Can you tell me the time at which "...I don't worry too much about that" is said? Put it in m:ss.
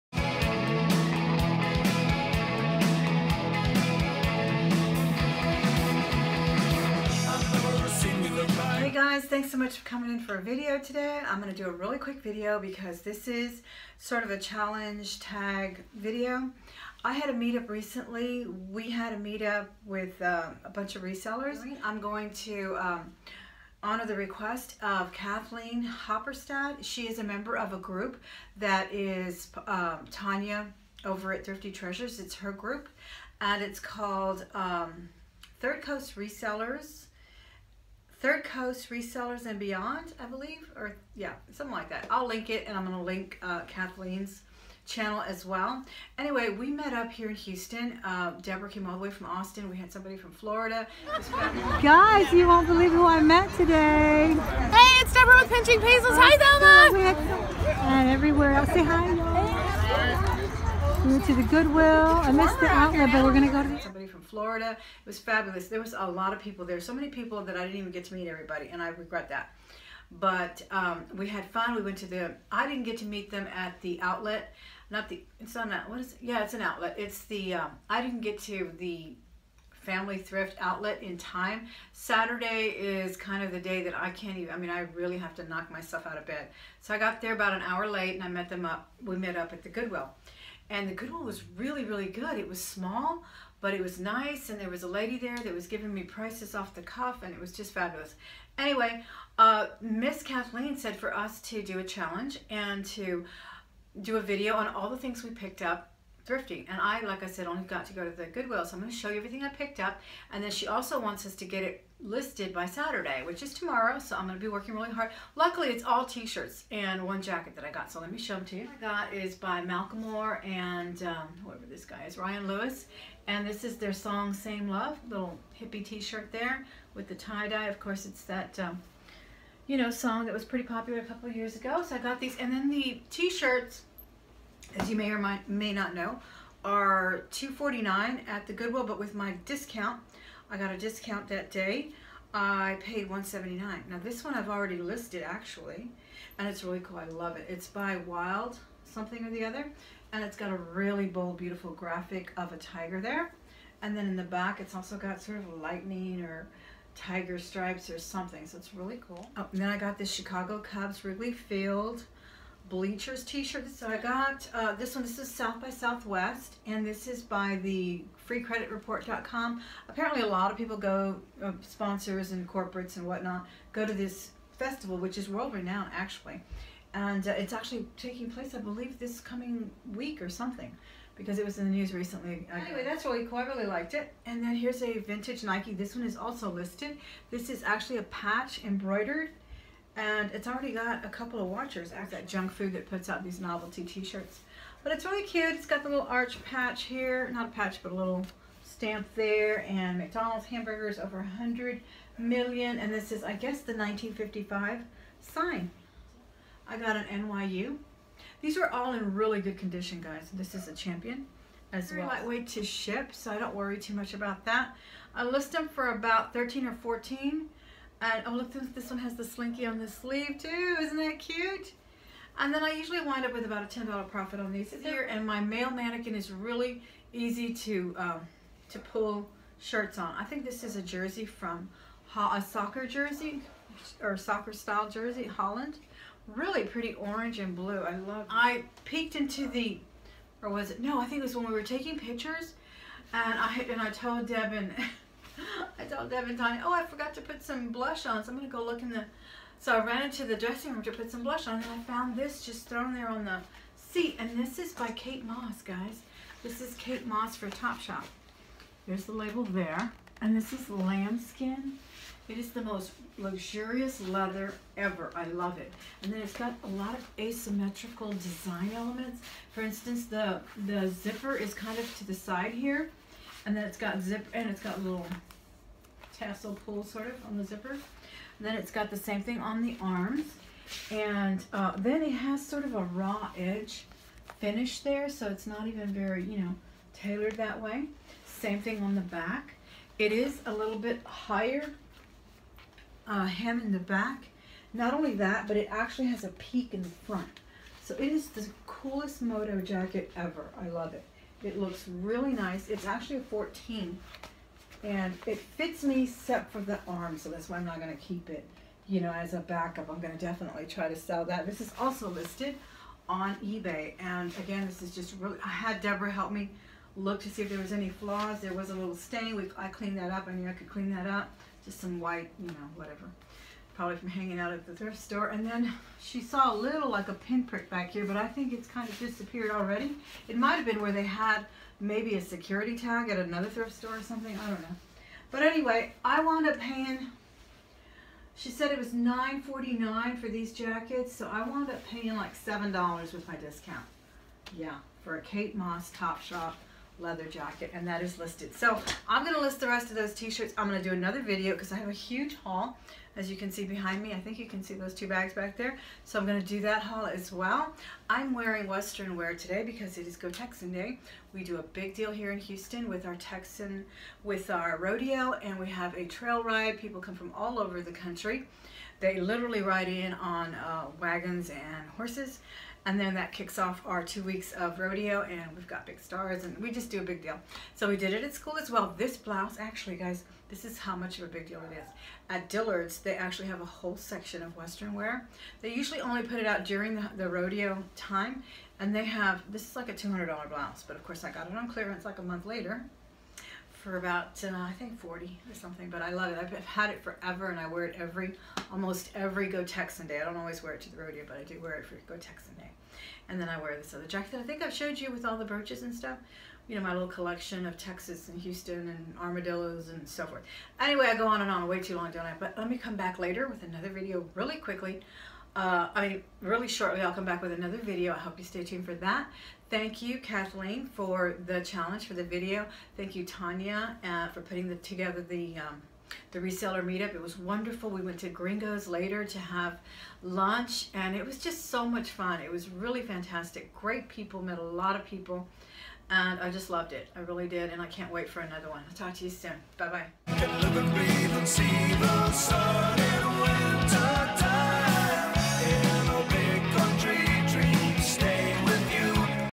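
3:33.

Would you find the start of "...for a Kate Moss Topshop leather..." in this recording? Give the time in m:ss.
5:45.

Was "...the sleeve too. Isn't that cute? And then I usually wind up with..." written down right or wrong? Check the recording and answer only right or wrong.
right.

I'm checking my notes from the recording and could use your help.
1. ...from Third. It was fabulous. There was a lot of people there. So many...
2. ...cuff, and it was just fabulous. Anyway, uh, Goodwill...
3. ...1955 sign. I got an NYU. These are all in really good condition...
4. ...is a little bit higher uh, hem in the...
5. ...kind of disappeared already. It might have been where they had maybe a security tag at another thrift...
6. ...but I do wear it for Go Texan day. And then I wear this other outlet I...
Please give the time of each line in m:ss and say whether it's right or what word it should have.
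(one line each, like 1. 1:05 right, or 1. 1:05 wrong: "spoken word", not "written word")
1. 1:04 wrong: "Florida", not "Third"
2. 1:36 wrong: "Miss", not "Goodwill"
3. 3:23 right
4. 4:50 right
5. 5:28 right
6. 6:41 wrong: "jacket", not "outlet".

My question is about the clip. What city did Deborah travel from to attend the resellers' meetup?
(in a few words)
Austin.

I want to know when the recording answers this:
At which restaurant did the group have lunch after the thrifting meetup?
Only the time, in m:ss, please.
7:08.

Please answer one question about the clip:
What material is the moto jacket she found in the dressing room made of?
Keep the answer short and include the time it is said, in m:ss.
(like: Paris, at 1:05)
Lambskin, at 4:20.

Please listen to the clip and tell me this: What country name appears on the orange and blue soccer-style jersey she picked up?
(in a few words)
Holland.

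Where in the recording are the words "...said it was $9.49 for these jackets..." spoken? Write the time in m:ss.
5:38.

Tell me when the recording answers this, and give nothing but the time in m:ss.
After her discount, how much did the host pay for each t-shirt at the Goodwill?
2:23.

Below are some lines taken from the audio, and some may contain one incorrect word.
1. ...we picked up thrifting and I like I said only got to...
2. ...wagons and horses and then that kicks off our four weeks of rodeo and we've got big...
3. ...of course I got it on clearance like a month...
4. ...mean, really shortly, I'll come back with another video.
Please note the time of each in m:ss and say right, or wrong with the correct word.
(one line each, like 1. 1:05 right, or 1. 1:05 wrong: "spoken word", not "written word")
1. 1:45 right
2. 6:10 wrong: "two", not "four"
3. 6:30 right
4. 6:56 right.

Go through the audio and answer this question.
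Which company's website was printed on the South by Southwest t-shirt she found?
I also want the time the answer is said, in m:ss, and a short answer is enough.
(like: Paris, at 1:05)
freecreditreport.com, at 2:48.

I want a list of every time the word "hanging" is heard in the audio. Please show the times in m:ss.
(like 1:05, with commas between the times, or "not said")
5:24.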